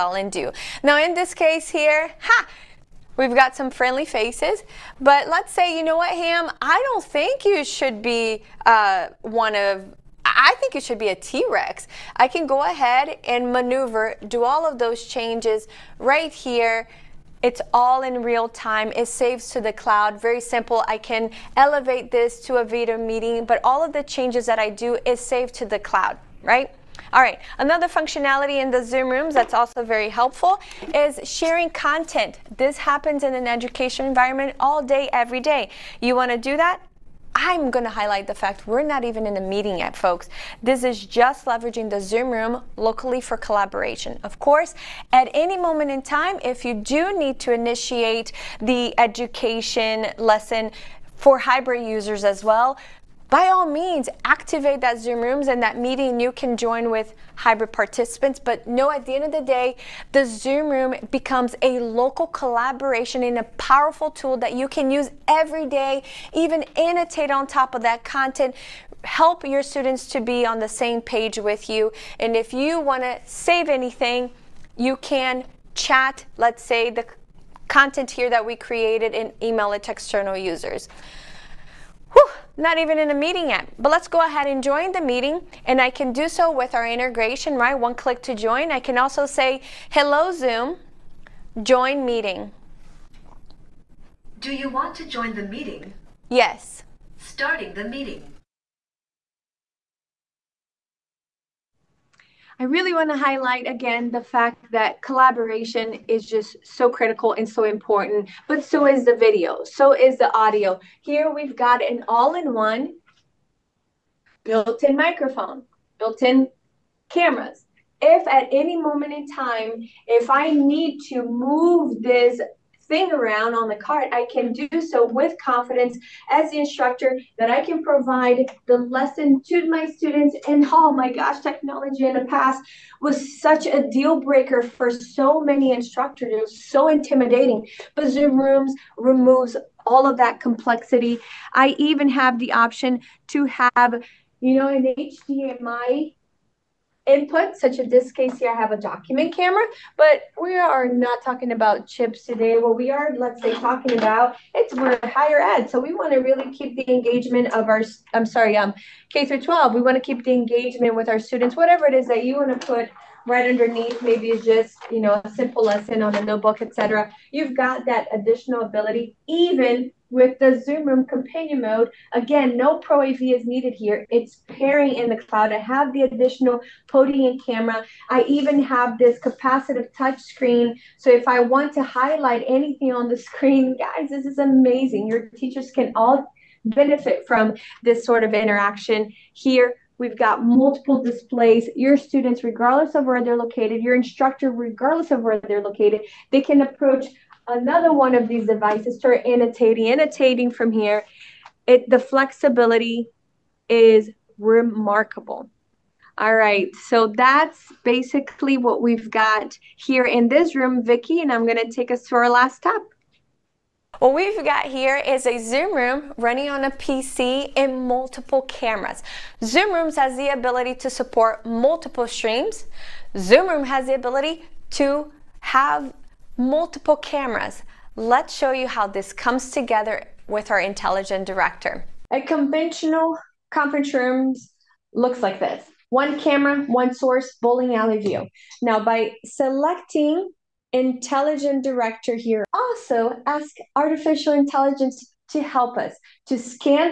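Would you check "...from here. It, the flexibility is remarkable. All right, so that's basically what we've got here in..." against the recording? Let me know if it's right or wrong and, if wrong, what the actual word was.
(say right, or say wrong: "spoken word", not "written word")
right.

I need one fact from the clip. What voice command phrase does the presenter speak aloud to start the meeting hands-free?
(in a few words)
Hello, Zoom, join meeting.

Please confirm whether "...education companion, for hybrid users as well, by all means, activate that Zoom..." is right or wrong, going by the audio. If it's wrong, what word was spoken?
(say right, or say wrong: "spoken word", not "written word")
wrong: "lesson", not "companion".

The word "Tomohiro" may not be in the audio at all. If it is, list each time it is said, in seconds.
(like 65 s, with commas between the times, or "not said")
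not said.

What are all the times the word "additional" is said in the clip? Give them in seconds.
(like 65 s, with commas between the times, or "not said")
168 s, 176 s.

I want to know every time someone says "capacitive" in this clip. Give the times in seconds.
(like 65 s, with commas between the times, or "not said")
179 s.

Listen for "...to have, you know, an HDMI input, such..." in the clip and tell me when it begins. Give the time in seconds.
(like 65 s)
143 s.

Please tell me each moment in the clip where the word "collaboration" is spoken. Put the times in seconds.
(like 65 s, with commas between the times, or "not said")
43 s, 62 s, 105 s.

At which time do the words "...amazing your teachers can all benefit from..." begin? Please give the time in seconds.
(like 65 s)
184 s.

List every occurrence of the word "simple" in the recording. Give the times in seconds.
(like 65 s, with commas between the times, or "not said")
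20 s, 165 s.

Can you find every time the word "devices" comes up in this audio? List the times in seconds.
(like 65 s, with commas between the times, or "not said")
198 s.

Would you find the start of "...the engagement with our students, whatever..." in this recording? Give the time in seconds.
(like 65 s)
160 s.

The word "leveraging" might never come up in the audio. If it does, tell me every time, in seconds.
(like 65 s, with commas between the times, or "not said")
41 s.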